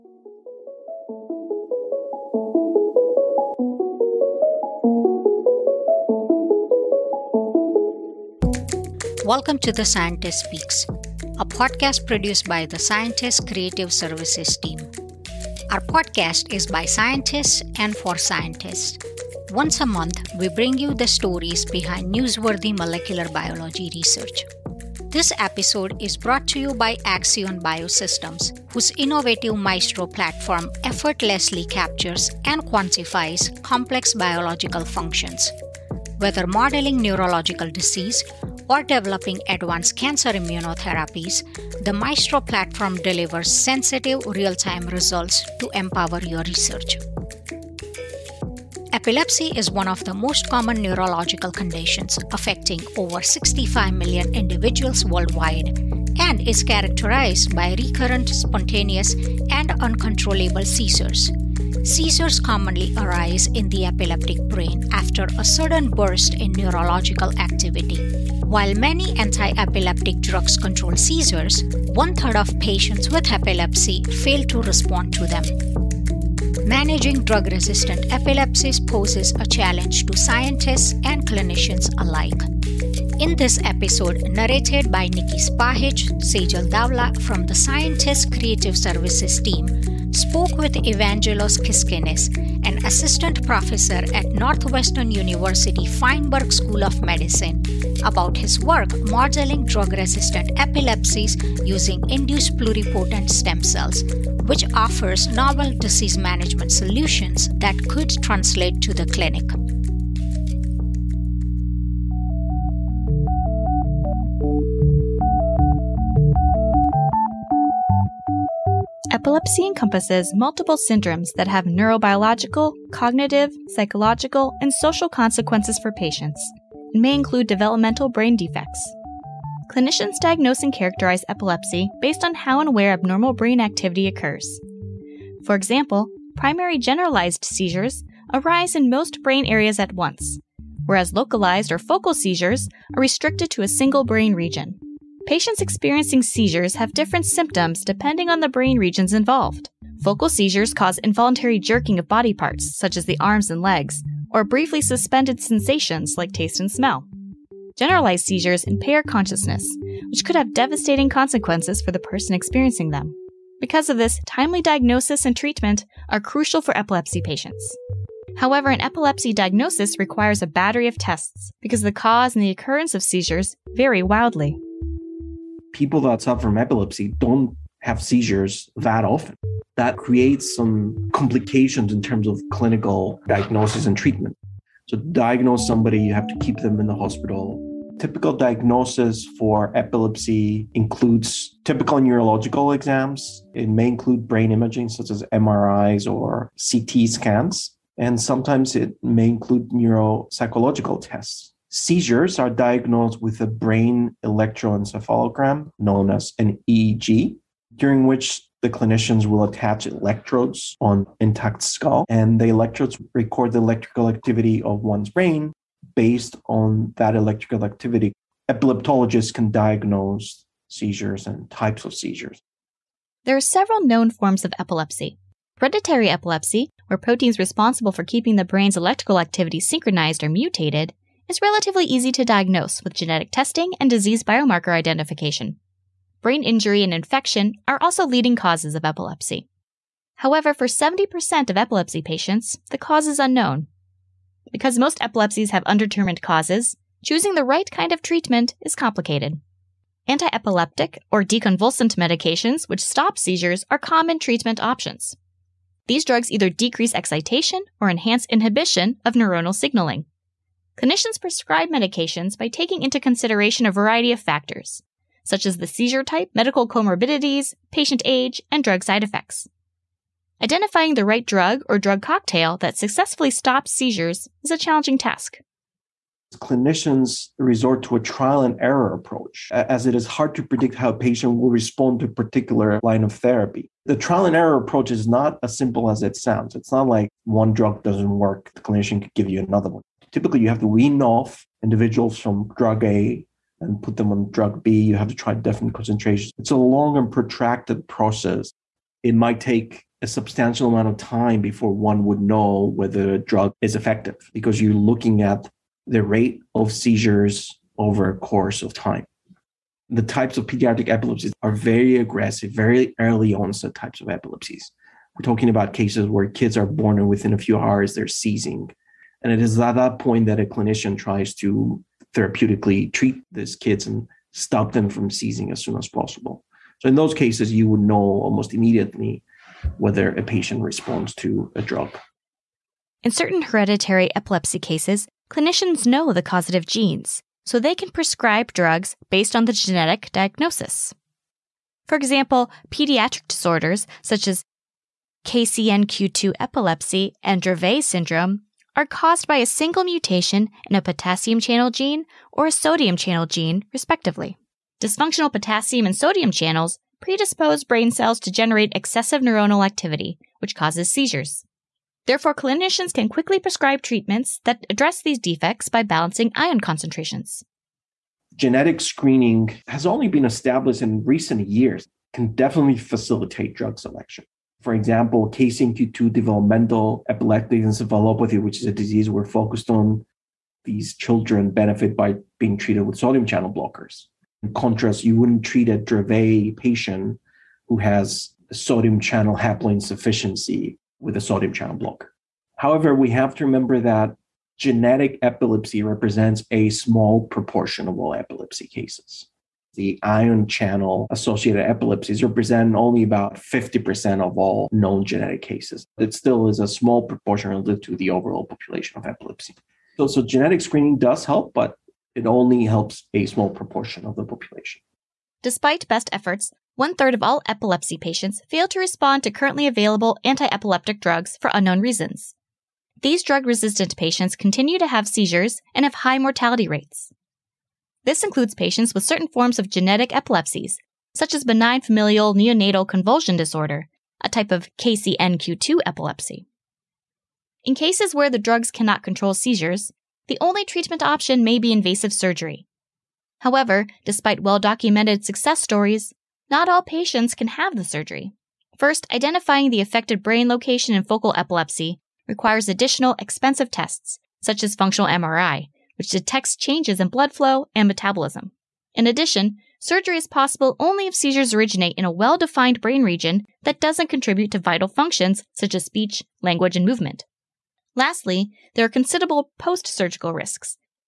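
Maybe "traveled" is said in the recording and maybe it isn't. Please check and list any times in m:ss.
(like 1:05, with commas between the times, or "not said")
not said.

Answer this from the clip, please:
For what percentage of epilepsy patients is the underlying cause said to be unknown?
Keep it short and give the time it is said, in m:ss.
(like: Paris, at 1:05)
70%, at 4:00.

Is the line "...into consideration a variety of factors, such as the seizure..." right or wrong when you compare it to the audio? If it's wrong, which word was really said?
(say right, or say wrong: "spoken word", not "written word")
right.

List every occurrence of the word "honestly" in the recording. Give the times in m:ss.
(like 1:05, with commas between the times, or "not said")
not said.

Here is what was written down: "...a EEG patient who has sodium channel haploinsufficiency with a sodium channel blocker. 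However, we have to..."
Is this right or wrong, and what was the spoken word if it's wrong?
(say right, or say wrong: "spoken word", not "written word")
wrong: "Dravet", not "EEG".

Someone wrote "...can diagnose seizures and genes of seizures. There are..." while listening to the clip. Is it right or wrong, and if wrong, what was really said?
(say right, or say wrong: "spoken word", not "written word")
wrong: "types", not "genes".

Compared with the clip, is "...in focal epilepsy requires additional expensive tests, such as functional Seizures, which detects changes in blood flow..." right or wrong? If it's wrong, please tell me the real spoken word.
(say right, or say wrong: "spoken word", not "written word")
wrong: "MRI", not "Seizures".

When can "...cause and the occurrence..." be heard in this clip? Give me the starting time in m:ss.
2:51.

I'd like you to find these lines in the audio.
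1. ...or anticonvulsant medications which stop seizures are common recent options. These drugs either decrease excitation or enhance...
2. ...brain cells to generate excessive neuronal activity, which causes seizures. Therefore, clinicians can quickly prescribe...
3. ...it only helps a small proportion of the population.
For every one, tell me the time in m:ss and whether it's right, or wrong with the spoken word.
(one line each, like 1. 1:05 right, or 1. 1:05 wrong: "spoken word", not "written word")
1. 4:11 wrong: "treatment", not "recent"
2. 5:57 right
3. 6:52 right.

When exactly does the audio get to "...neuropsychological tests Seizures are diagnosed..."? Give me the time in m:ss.
3:19.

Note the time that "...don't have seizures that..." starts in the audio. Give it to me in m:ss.
2:57.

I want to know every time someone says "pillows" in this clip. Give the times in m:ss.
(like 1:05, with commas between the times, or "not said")
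not said.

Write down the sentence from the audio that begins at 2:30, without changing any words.
Focal seizures cause involuntary jerking of body parts, such as the arms and legs, or briefly suspended sensations like taste and smell.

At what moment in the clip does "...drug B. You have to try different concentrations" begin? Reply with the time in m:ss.
4:54.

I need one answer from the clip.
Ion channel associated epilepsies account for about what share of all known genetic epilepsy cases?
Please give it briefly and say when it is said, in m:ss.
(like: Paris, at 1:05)
50%, at 6:43.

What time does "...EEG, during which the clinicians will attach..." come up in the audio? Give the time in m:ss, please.
3:26.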